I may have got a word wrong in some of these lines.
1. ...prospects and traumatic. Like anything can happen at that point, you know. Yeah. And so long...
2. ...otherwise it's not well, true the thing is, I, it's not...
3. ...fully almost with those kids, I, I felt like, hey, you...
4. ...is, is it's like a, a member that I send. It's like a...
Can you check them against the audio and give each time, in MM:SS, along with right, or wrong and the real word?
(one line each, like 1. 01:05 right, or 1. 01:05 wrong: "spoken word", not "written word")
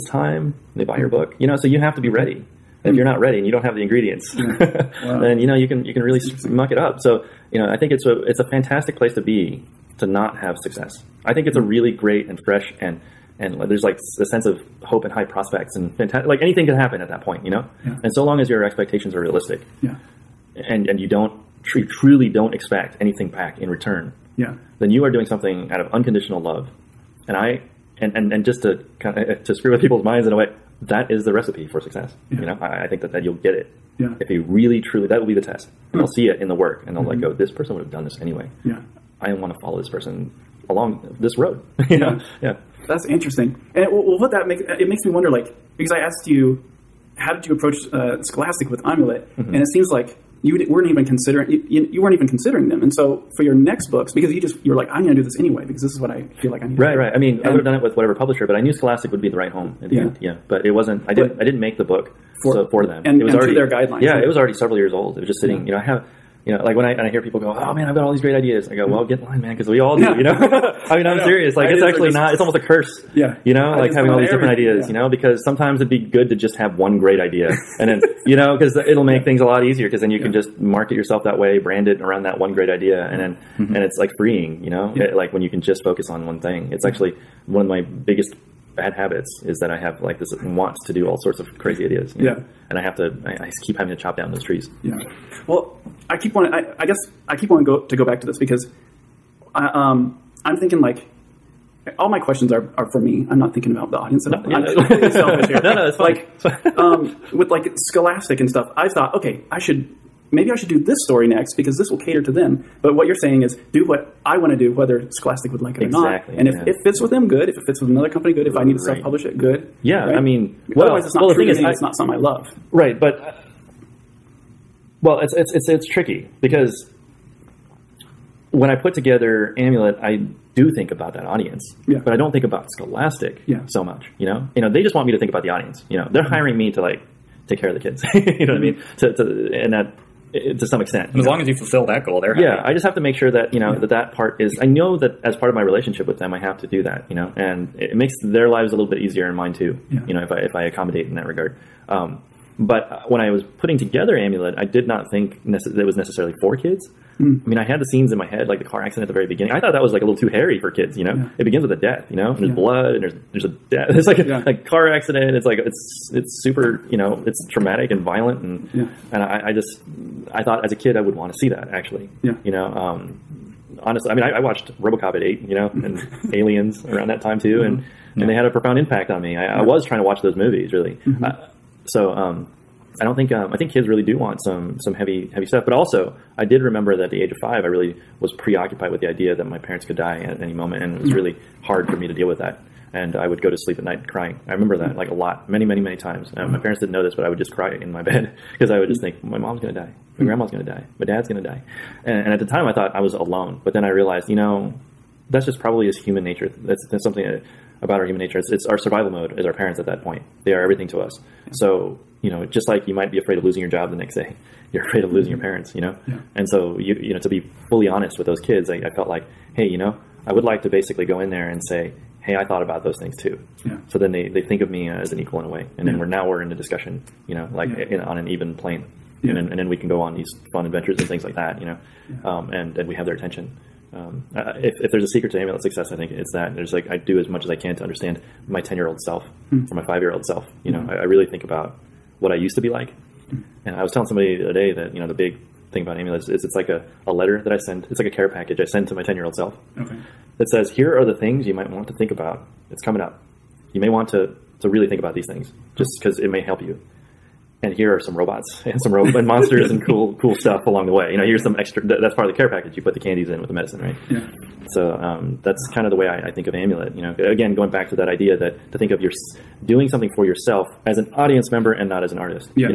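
1. 00:15 wrong: "fantastic", not "traumatic"
2. 02:00 right
3. 03:37 wrong: "honest", not "almost"
4. 04:06 wrong: "letter", not "member".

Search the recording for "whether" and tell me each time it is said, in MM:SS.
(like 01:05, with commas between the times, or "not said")
01:54.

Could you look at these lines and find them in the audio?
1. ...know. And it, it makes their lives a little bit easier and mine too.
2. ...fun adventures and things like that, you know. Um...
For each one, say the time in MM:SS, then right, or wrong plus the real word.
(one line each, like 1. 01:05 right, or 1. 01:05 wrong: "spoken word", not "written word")
1. 02:27 right
2. 03:50 right.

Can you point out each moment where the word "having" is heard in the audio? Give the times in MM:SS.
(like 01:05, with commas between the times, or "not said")
01:13, 01:33.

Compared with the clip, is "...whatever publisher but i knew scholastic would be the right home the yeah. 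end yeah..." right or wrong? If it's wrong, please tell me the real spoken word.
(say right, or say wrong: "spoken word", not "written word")
right.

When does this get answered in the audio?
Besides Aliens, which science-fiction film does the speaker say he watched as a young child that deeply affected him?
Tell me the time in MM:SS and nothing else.
02:54.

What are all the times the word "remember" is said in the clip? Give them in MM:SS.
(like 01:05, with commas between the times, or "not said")
03:06, 03:14.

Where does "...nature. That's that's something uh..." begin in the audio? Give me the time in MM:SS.
03:26.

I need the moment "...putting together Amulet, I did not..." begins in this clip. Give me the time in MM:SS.
02:33.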